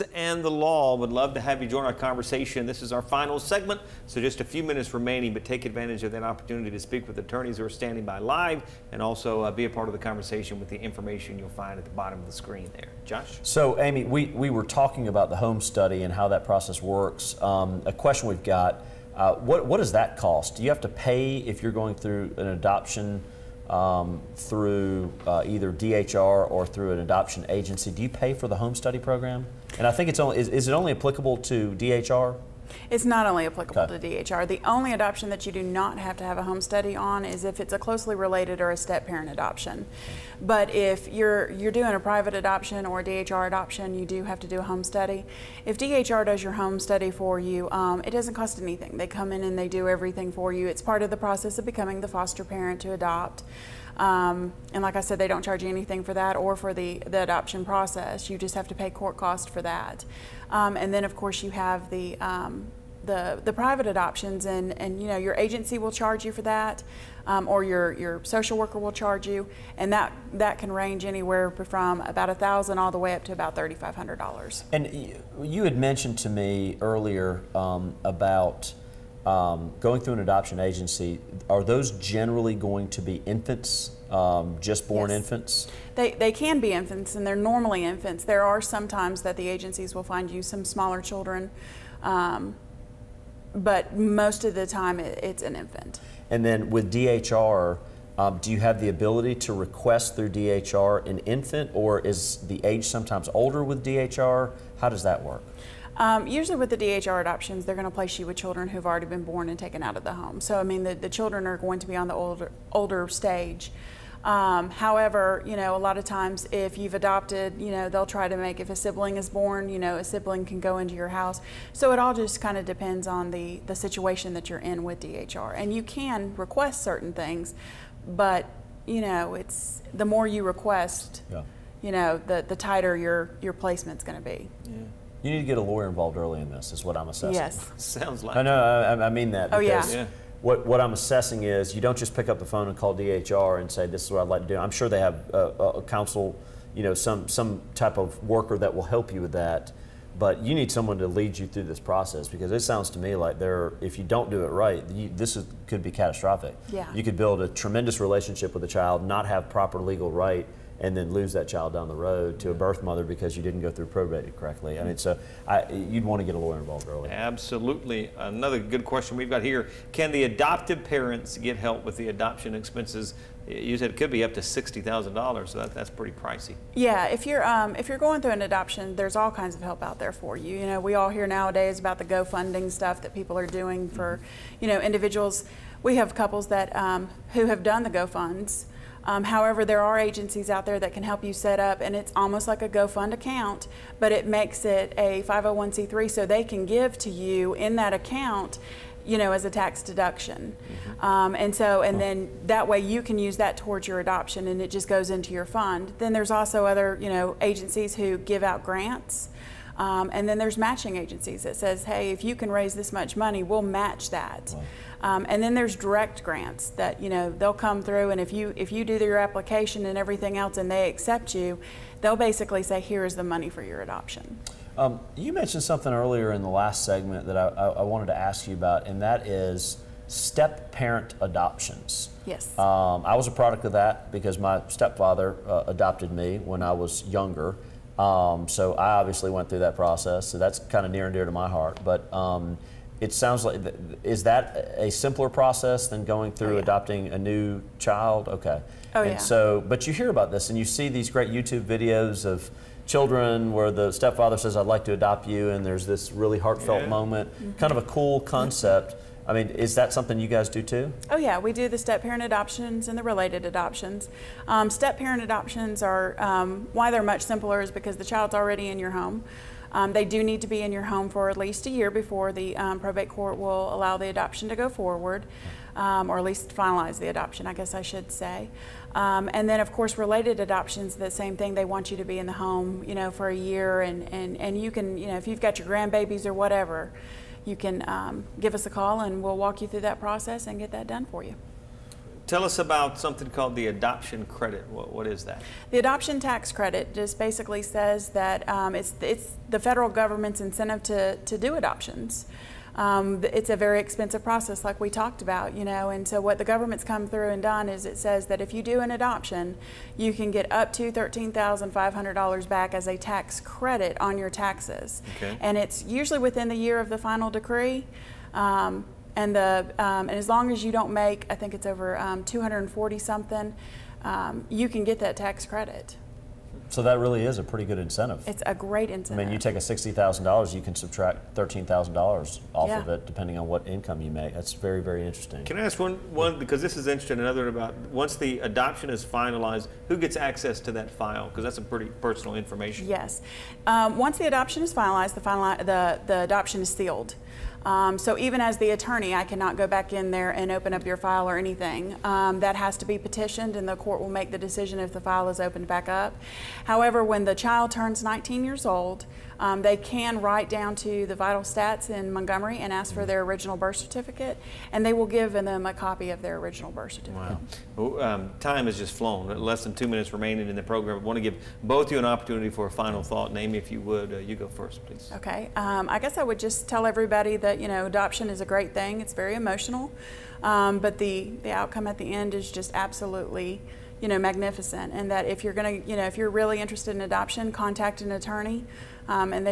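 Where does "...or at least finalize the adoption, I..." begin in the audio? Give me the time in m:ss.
4:36.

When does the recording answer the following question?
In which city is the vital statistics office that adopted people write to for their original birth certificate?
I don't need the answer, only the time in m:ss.
6:02.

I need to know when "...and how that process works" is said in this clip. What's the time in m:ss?
0:16.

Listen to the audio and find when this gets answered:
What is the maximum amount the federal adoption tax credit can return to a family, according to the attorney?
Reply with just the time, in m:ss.
5:10.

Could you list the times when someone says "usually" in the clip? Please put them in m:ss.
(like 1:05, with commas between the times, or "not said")
1:46, 5:15.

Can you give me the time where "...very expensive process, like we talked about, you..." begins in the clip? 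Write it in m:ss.
5:03.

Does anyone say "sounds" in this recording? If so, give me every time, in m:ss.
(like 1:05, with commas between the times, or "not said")
2:17, 2:32, 4:03.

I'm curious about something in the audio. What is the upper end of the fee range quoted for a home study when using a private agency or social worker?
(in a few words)
$3,500.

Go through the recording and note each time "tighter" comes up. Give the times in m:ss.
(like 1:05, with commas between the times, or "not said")
2:12.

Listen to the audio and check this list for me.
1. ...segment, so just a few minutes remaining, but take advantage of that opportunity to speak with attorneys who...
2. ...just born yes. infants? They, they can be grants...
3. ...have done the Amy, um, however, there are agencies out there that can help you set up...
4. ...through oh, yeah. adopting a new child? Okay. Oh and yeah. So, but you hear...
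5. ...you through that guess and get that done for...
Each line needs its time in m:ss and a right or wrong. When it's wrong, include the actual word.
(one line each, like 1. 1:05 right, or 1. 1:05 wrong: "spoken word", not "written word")
1. 0:03 right
2. 1:24 wrong: "infants", not "grants"
3. 3:07 wrong: "GoFunds", not "Amy"
4. 4:06 right
5. 4:49 wrong: "process", not "guess".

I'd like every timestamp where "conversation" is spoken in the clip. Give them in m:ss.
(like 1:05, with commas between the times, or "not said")
0:01, 0:09.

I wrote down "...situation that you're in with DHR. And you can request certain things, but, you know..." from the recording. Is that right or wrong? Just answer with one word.
right.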